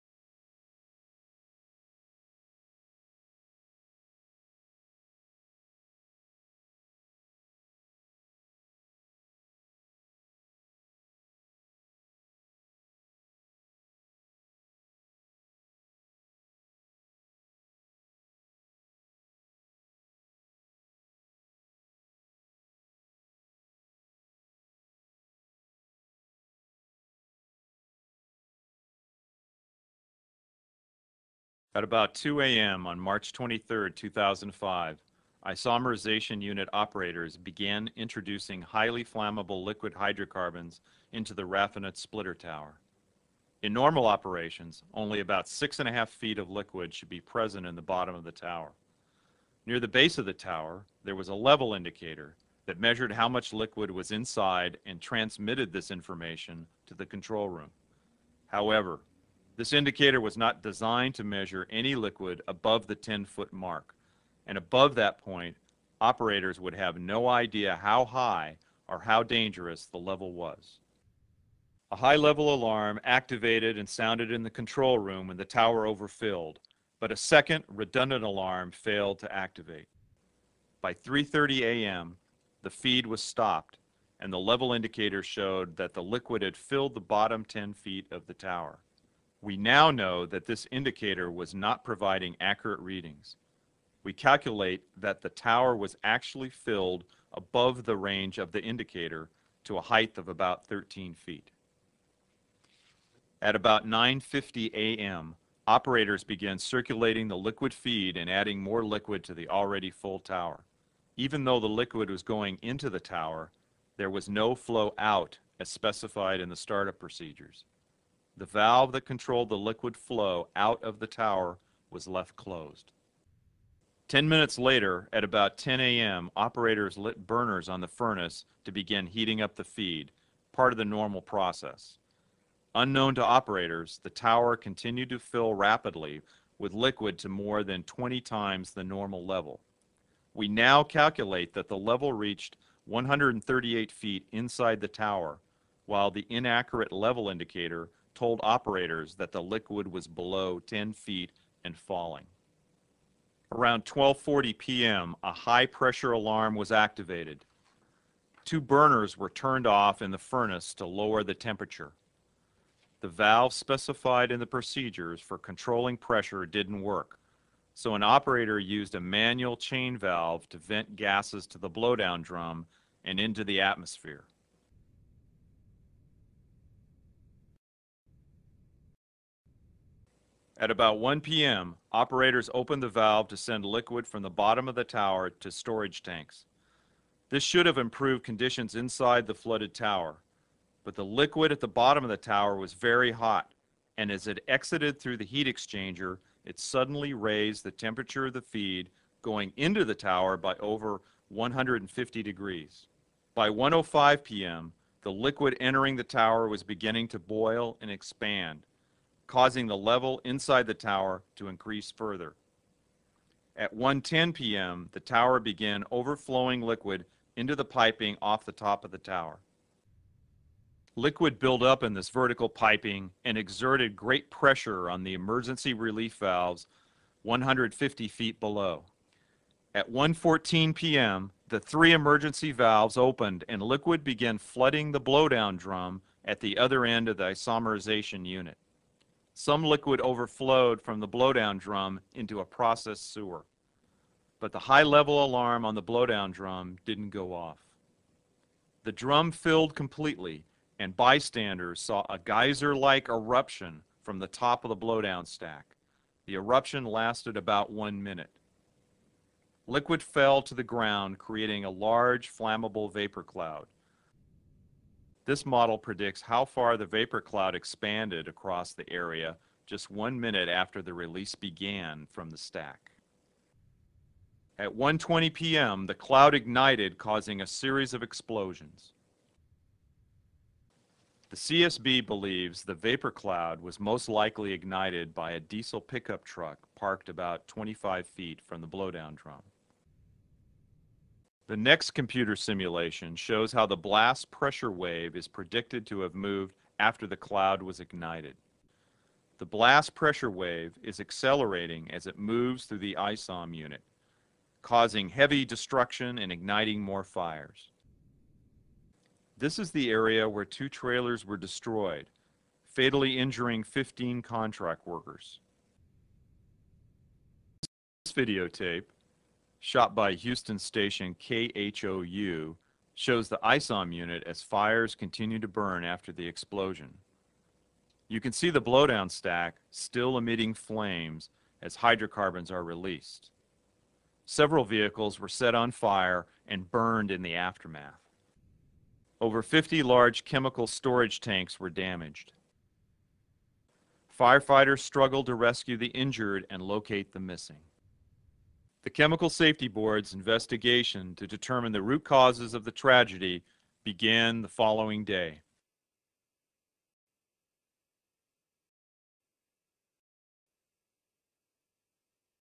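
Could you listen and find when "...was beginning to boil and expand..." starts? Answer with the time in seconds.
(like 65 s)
206 s.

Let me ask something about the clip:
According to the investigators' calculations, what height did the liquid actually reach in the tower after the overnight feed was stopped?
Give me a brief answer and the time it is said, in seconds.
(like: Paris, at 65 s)
13 feet, at 100 s.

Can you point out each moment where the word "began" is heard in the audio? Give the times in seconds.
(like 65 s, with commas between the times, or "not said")
37 s, 106 s, 215 s, 234 s, 271 s, 353 s.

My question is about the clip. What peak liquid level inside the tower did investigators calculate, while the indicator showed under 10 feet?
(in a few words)
138 feet.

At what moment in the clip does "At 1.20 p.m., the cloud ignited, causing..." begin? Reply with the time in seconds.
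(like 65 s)
274 s.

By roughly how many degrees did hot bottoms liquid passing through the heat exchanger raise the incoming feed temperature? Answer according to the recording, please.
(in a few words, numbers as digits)
over 150 degrees.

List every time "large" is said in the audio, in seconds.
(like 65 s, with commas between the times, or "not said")
261 s, 339 s.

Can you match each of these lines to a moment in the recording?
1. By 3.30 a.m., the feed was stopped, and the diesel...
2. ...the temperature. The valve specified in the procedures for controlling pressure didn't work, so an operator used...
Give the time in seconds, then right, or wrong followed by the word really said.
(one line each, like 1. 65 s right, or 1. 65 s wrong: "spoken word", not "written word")
1. 80 s wrong: "level", not "diesel"
2. 161 s right.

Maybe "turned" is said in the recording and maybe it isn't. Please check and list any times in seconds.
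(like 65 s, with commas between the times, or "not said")
159 s.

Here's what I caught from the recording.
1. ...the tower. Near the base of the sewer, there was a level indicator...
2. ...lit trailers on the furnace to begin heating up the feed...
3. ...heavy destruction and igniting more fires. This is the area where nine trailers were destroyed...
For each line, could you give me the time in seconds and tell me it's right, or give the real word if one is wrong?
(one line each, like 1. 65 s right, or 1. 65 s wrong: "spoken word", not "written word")
1. 48 s wrong: "tower", not "sewer"
2. 126 s wrong: "burners", not "trailers"
3. 305 s wrong: "two", not "nine".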